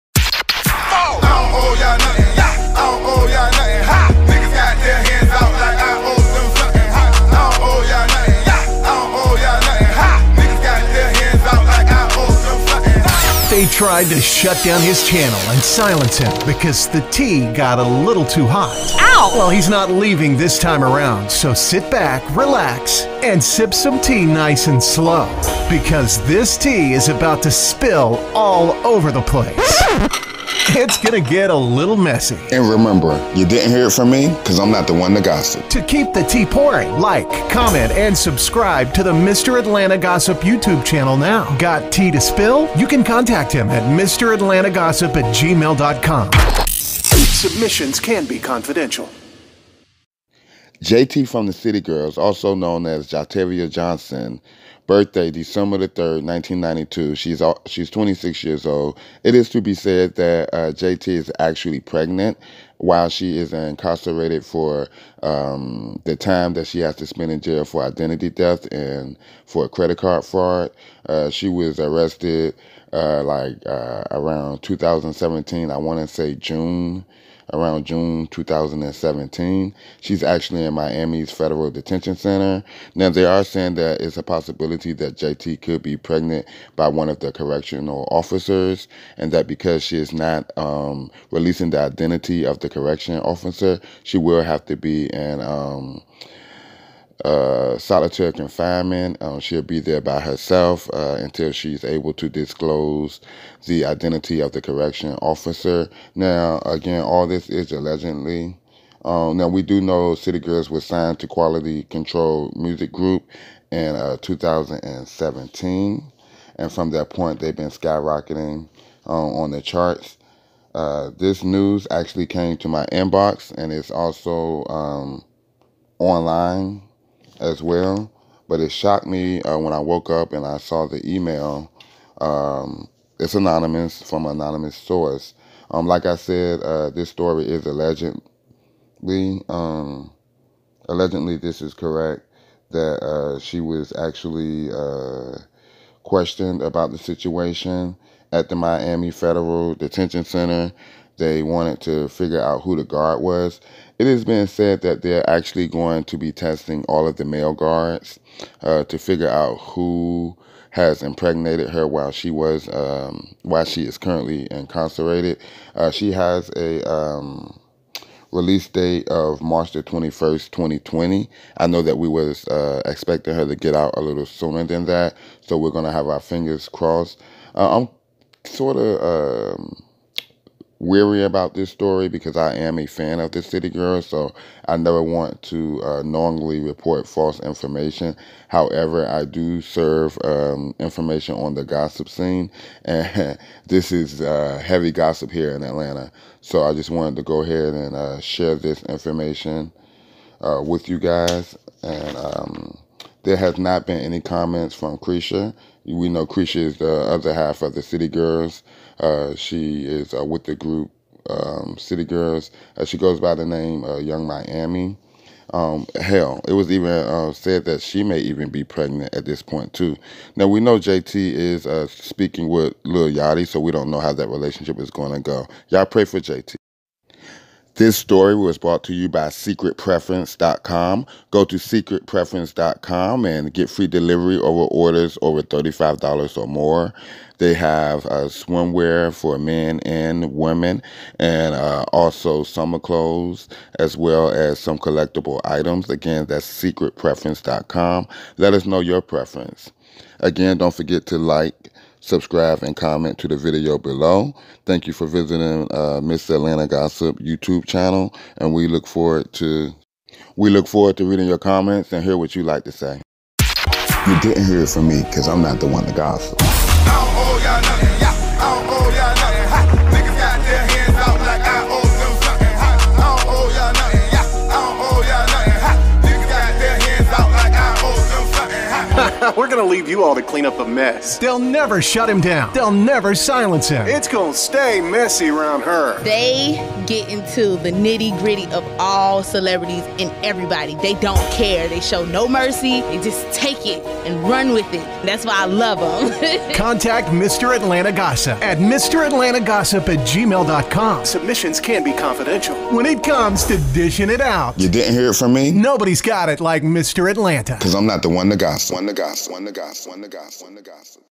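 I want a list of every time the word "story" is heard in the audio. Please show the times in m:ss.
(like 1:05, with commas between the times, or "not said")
2:17, 3:01, 3:47.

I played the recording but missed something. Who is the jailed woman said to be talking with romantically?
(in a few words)
Lil Yachty.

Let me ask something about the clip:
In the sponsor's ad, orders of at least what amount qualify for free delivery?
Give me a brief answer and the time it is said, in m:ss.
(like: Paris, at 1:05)
$35, at 3:55.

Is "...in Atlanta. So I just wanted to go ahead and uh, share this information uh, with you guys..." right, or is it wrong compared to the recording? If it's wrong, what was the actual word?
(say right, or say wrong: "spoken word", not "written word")
right.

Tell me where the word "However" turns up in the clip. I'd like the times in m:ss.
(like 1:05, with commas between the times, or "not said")
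3:08.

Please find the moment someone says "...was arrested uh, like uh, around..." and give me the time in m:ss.
1:11.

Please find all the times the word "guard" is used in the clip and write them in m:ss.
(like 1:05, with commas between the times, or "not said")
2:32, 2:37.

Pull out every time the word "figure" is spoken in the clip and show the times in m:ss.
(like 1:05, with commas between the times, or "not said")
2:32, 2:38.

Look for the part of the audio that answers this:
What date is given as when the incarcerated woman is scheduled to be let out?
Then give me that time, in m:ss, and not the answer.
2:49.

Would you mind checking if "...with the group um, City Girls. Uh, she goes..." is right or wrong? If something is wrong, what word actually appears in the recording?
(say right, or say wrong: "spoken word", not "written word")
right.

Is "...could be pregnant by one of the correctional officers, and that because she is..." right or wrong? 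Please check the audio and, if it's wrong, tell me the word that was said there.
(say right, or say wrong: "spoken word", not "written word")
right.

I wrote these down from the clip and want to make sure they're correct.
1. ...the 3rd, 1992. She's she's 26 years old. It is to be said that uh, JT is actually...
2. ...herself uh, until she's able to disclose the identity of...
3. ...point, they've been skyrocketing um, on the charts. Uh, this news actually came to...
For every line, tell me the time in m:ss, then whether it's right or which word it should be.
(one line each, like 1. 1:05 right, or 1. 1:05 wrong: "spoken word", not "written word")
1. 0:55 right
2. 1:40 right
3. 1:57 right.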